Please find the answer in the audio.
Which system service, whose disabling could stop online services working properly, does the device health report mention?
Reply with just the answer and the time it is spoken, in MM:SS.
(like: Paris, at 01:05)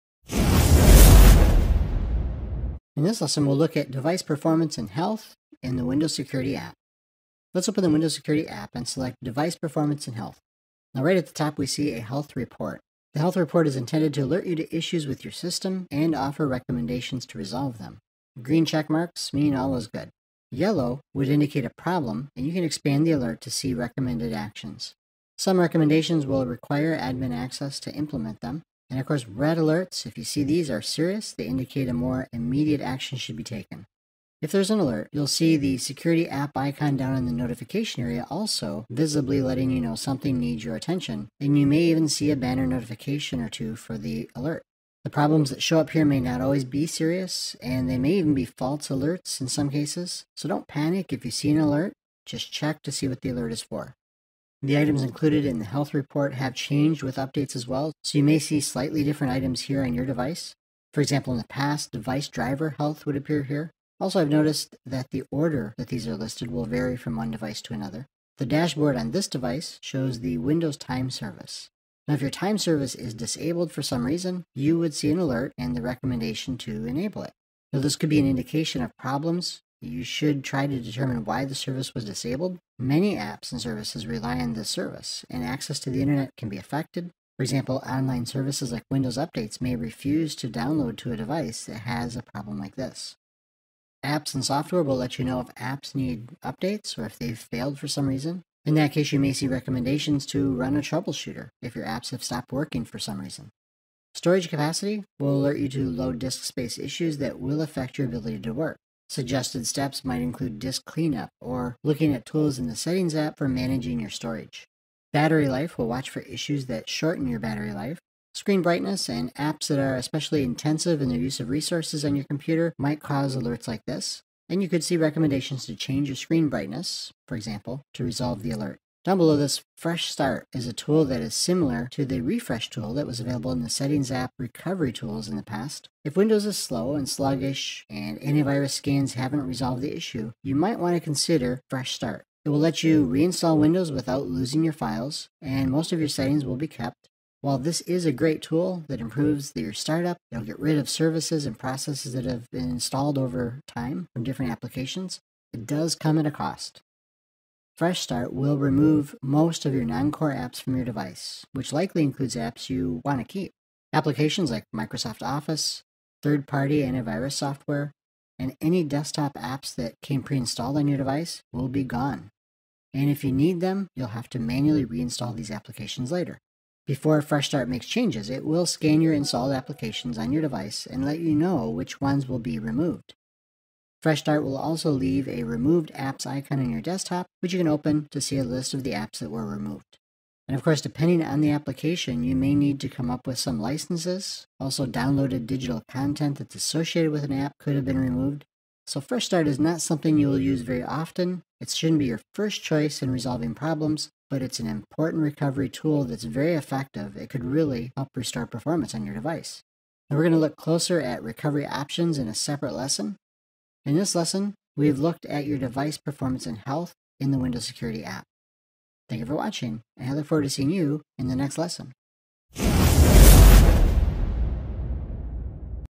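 Windows time service, at 01:10.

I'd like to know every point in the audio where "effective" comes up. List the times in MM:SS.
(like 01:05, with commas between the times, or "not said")
03:26.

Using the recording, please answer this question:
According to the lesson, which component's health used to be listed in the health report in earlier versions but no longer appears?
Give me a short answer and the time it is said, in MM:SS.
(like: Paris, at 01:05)
Device driver health, at 01:01.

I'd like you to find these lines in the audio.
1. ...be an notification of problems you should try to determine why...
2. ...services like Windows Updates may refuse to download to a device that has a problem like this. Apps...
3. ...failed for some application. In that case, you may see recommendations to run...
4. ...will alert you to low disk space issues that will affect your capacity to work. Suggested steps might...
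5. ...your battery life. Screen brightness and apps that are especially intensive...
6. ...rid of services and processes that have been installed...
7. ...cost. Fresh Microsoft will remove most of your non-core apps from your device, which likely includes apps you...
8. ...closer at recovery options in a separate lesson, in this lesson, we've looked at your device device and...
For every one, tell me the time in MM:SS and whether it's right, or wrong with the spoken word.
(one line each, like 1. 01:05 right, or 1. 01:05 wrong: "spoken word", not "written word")
1. 01:18 wrong: "indication", not "notification"
2. 01:28 right
3. 01:37 wrong: "reason", not "application"
4. 01:45 wrong: "ability", not "capacity"
5. 01:57 right
6. 02:30 right
7. 02:36 wrong: "Start", not "Microsoft"
8. 03:30 wrong: "performance", not "device".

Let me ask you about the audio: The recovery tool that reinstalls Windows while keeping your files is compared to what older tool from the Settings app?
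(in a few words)
Refresh tool.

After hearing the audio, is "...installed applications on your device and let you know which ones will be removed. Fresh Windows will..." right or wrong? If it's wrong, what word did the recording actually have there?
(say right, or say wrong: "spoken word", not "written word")
wrong: "Start", not "Windows".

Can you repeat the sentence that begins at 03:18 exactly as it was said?
So Fresh Start is not something you will use very often.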